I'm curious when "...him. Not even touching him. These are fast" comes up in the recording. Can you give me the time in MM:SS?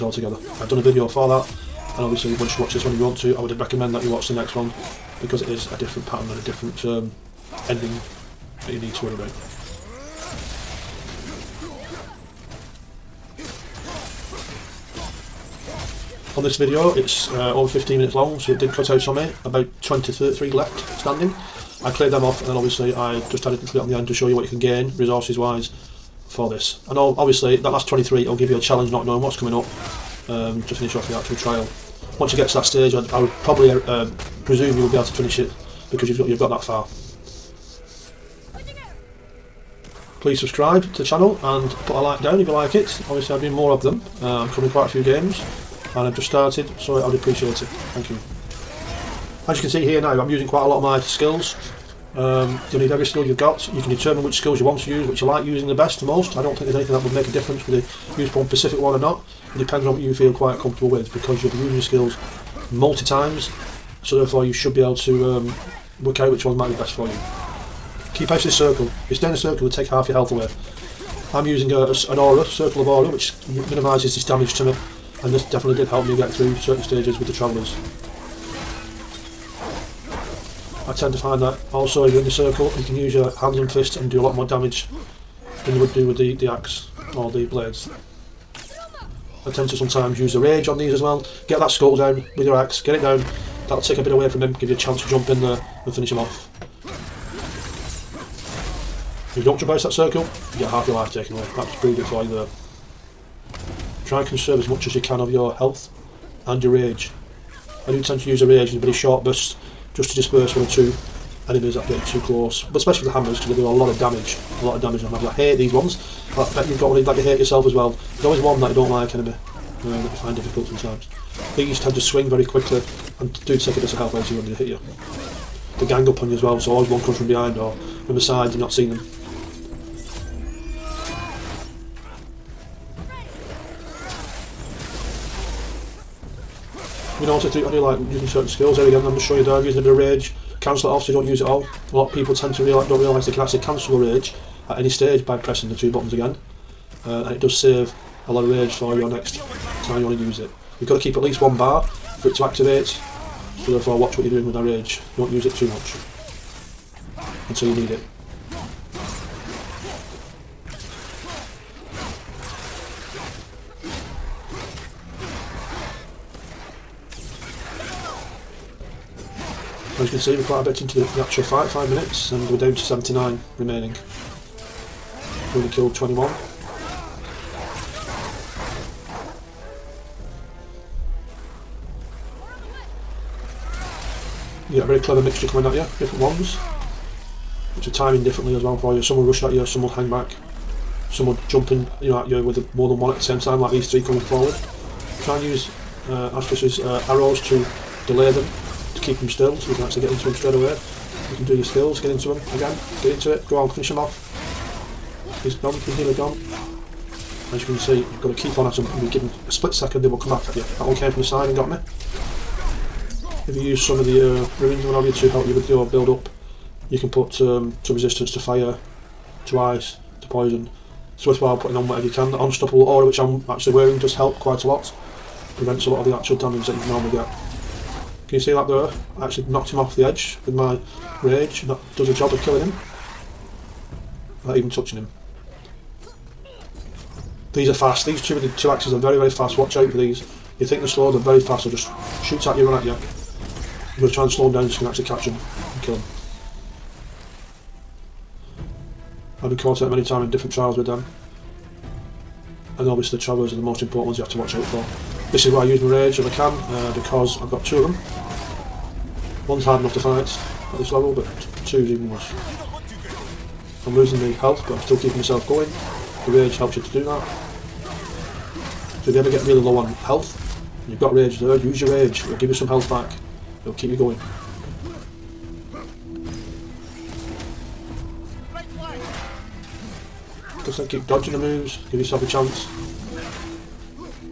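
03:52.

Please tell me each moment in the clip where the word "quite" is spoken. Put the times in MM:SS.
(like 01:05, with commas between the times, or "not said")
00:44, 00:50, 01:00, 02:50, 03:44.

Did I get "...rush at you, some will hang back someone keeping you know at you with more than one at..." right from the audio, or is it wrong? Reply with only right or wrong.
wrong.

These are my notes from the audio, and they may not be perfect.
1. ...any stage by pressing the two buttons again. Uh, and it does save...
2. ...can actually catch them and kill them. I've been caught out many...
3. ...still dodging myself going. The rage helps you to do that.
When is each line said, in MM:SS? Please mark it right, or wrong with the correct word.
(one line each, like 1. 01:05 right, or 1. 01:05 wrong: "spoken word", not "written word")
1. 02:24 right
2. 04:04 right
3. 04:24 wrong: "keeping", not "dodging".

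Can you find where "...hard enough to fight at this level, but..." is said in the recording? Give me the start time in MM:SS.
04:19.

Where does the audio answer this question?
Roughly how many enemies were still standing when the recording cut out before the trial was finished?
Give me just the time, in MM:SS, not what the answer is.
00:19.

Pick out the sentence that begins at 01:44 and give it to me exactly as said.
Try and conserve as much as you can of your health and your rage.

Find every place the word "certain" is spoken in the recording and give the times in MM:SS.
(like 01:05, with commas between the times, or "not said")
01:16, 02:18.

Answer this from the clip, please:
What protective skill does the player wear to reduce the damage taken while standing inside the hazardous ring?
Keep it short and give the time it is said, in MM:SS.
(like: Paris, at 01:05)
Circle of aura, at 01:12.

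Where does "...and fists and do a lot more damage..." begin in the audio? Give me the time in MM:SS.
01:23.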